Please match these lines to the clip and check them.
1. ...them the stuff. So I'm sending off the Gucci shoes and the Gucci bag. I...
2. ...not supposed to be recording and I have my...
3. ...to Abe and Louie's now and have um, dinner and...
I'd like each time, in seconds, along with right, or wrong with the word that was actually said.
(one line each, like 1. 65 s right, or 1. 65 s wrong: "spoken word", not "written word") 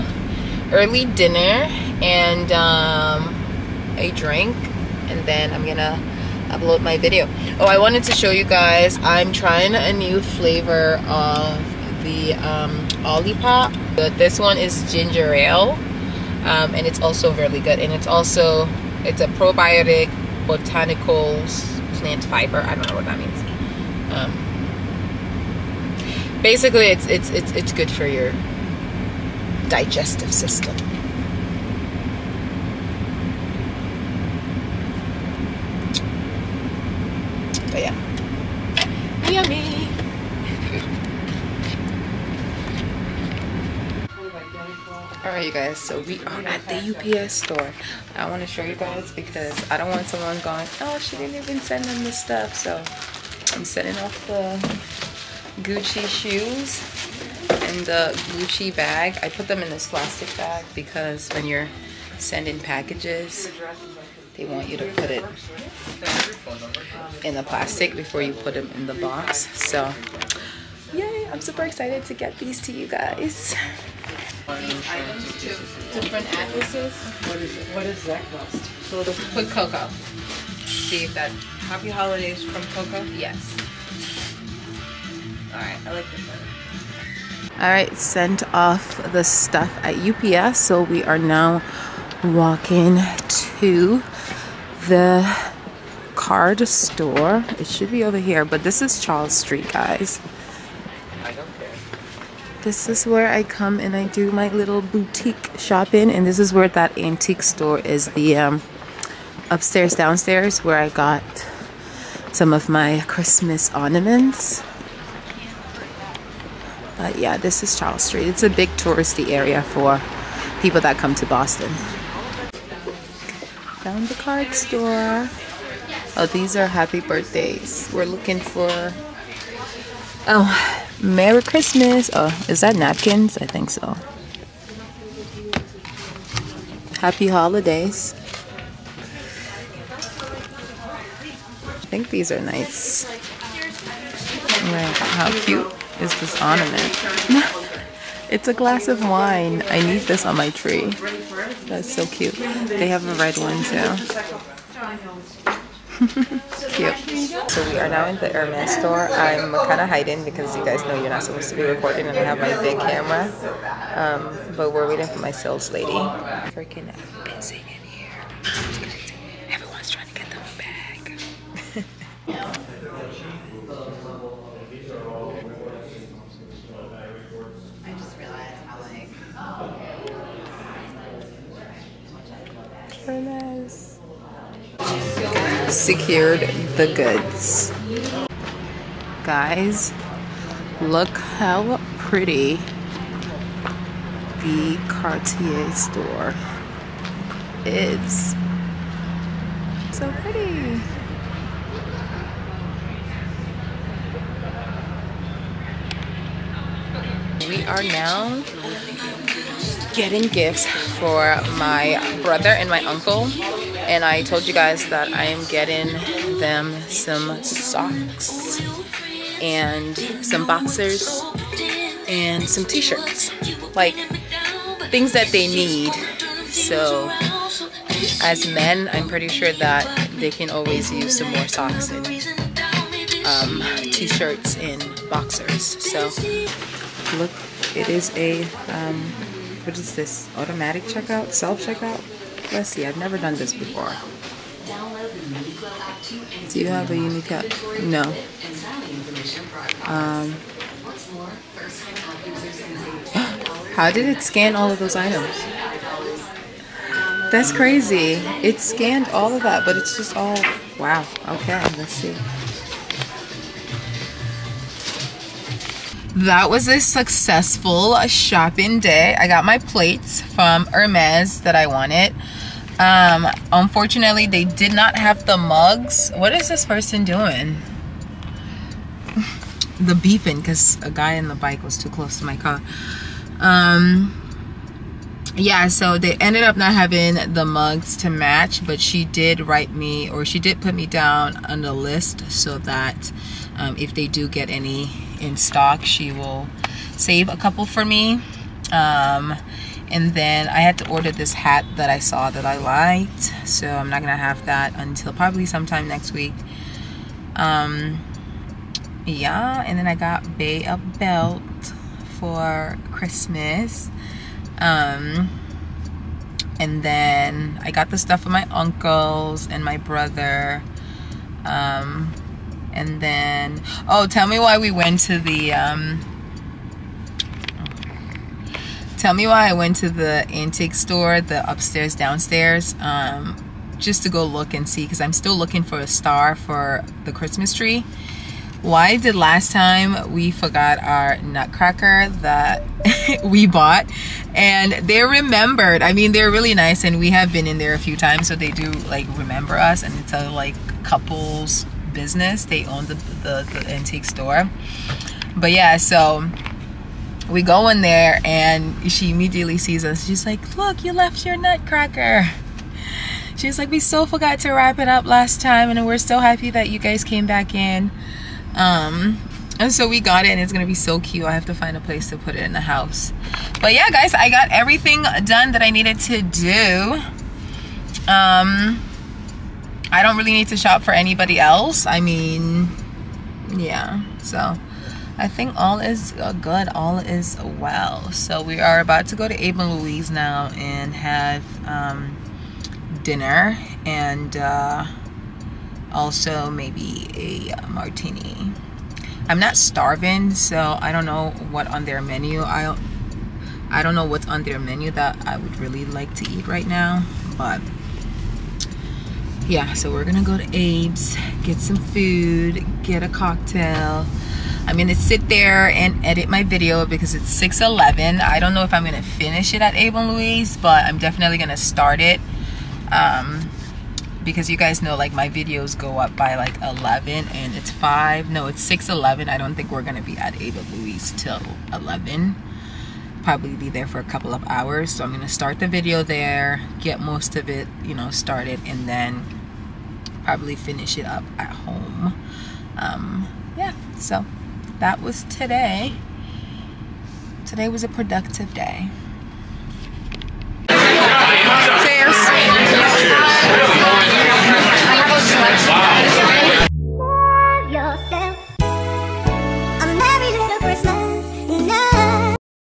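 1. 51 s right
2. 161 s right
3. 389 s right.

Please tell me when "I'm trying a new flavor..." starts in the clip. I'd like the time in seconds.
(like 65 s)
9 s.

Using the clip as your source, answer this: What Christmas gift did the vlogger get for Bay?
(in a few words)
A belt.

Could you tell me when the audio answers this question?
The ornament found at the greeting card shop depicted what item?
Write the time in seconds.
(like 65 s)
148 s.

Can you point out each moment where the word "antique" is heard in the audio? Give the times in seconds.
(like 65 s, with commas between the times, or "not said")
106 s, 330 s, 353 s.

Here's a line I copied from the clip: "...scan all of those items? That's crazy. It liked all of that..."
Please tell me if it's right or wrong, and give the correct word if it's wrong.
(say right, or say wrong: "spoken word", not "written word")
wrong: "scanned", not "liked".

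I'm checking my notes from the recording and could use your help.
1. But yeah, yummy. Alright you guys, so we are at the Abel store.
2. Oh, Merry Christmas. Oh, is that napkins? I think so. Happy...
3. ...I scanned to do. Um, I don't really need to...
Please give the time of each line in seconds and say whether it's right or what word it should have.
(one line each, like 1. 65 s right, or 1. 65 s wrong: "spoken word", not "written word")
1. 37 s wrong: "UPS", not "Abel"
2. 130 s right
3. 375 s wrong: "needed", not "scanned".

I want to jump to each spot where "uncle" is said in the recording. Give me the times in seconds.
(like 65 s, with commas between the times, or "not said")
212 s, 318 s.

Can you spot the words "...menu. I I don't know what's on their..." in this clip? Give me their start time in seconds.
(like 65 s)
401 s.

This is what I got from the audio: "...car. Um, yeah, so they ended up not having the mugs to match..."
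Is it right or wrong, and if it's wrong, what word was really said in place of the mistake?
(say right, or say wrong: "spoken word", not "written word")
right.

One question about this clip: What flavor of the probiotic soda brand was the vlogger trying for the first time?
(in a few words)
Ginger ale.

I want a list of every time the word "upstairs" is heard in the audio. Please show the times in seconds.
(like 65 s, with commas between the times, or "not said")
109 s, 331 s.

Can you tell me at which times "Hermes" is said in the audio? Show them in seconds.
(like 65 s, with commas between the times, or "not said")
158 s, 270 s.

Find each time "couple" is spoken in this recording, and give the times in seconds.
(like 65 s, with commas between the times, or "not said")
297 s, 350 s, 434 s.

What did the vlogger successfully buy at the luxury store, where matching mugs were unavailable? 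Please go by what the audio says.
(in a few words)
Plates.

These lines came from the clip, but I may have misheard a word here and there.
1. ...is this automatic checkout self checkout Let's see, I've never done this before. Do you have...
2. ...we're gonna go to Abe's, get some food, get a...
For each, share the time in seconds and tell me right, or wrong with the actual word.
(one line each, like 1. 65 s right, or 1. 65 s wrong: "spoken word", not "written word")
1. 239 s right
2. 409 s right.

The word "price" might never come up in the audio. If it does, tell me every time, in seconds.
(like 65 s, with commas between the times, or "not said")
not said.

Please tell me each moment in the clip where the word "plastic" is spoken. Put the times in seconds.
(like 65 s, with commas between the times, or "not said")
59 s, 67 s.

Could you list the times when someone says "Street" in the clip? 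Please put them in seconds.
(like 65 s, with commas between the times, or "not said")
99 s, 118 s.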